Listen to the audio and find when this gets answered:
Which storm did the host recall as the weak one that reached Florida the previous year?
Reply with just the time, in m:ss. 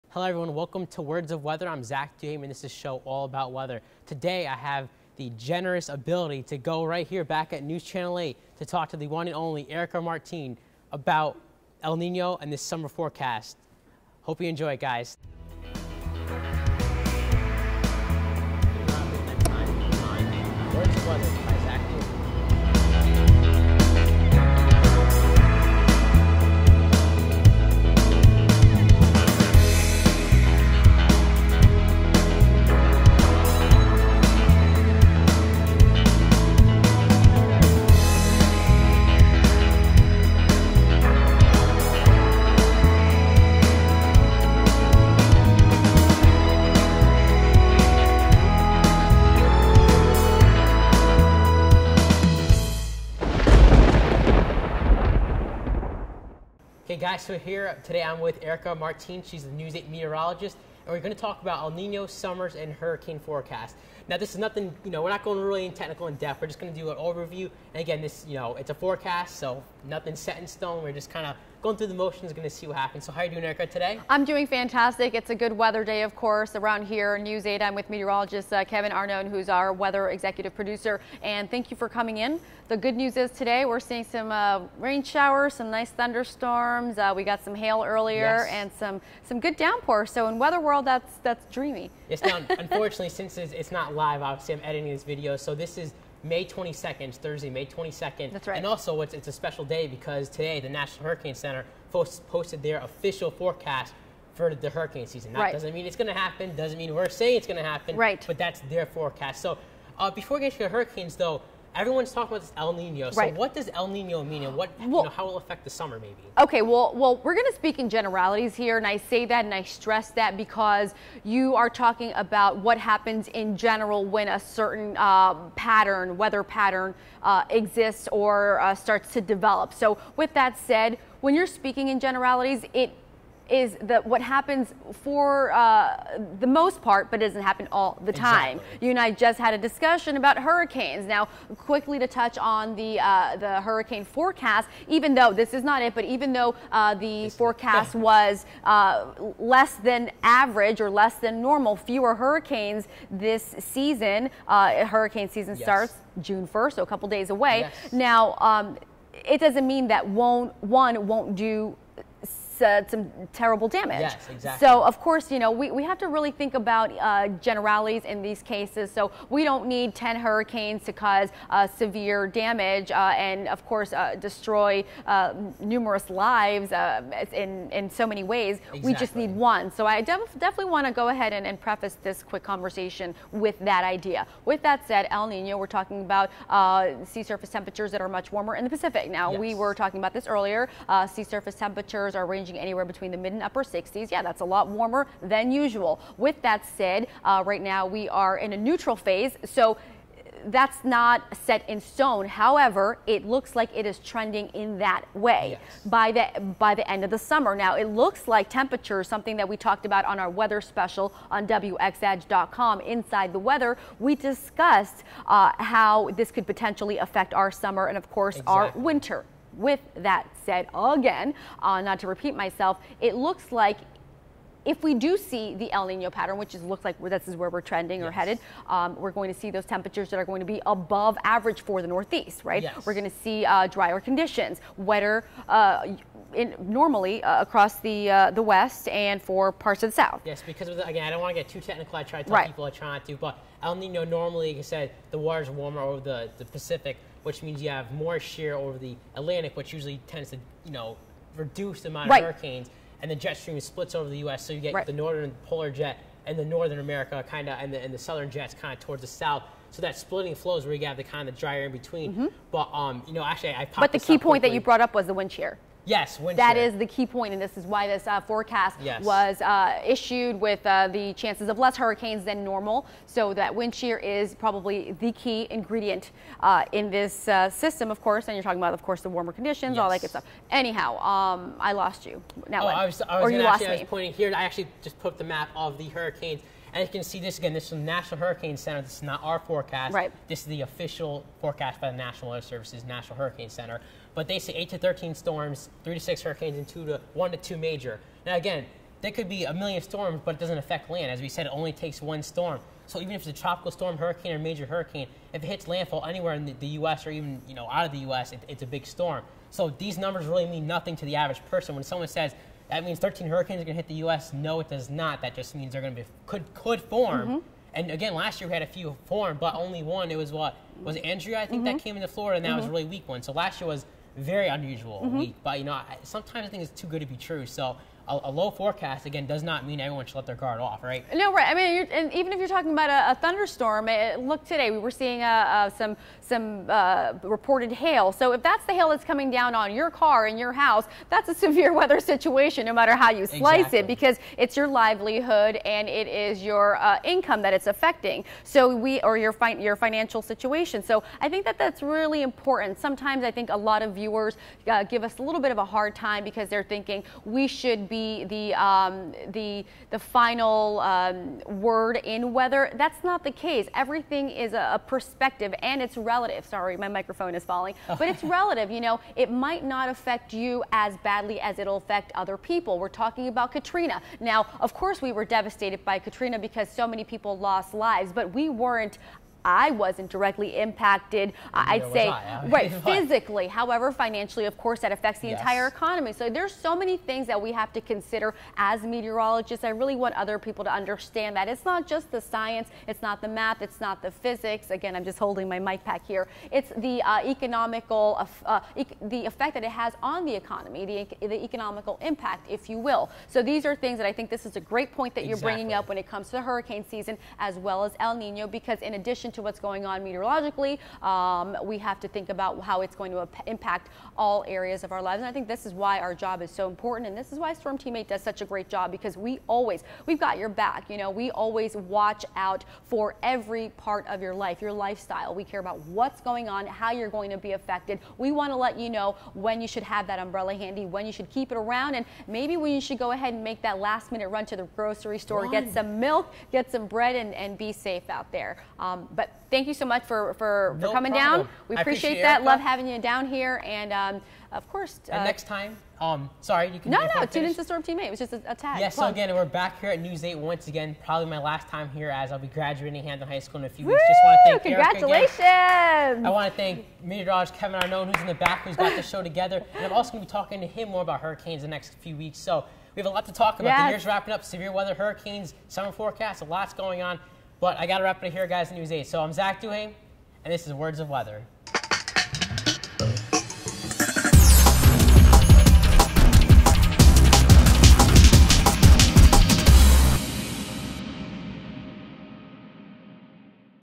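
5:21.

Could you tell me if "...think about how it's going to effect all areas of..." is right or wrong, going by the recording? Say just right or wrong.
wrong.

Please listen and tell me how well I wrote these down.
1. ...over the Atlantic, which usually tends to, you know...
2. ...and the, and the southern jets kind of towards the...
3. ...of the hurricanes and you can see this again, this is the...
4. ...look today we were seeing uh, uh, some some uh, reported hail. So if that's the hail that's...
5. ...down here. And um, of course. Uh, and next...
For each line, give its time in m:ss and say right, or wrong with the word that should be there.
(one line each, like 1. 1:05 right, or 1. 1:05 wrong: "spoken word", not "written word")
1. 4:08 right
2. 4:17 right
3. 4:45 right
4. 5:34 right
5. 7:22 right.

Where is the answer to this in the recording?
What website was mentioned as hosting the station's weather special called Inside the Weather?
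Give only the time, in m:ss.
3:31.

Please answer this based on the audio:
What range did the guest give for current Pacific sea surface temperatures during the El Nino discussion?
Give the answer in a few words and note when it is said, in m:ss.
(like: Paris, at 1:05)
mid and upper 60s, at 3:13.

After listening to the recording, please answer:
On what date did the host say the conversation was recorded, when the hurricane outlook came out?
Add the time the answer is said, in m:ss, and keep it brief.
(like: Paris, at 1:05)
May 22nd, at 1:37.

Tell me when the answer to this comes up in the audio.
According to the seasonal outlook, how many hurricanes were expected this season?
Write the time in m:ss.
4:55.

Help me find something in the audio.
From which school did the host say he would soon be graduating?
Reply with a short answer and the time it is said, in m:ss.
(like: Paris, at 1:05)
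Hamden High School, at 7:33.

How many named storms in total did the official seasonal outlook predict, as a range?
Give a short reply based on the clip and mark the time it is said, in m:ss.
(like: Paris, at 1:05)
8 to 13, at 4:54.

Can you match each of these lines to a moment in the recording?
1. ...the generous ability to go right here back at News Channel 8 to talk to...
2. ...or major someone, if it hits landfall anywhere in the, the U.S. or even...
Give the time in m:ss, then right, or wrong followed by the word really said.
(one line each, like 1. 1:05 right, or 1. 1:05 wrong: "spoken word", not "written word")
1. 0:05 right
2. 5:04 wrong: "hurricane", not "someone".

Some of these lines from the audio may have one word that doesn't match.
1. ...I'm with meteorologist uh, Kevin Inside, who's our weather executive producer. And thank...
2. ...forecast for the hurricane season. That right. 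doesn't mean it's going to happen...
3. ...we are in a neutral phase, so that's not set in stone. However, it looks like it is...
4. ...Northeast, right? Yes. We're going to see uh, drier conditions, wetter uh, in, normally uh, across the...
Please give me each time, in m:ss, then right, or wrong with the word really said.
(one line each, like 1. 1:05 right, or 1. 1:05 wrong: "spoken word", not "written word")
1. 1:17 wrong: "Arnone", not "Inside"
2. 1:43 right
3. 3:17 right
4. 3:51 right.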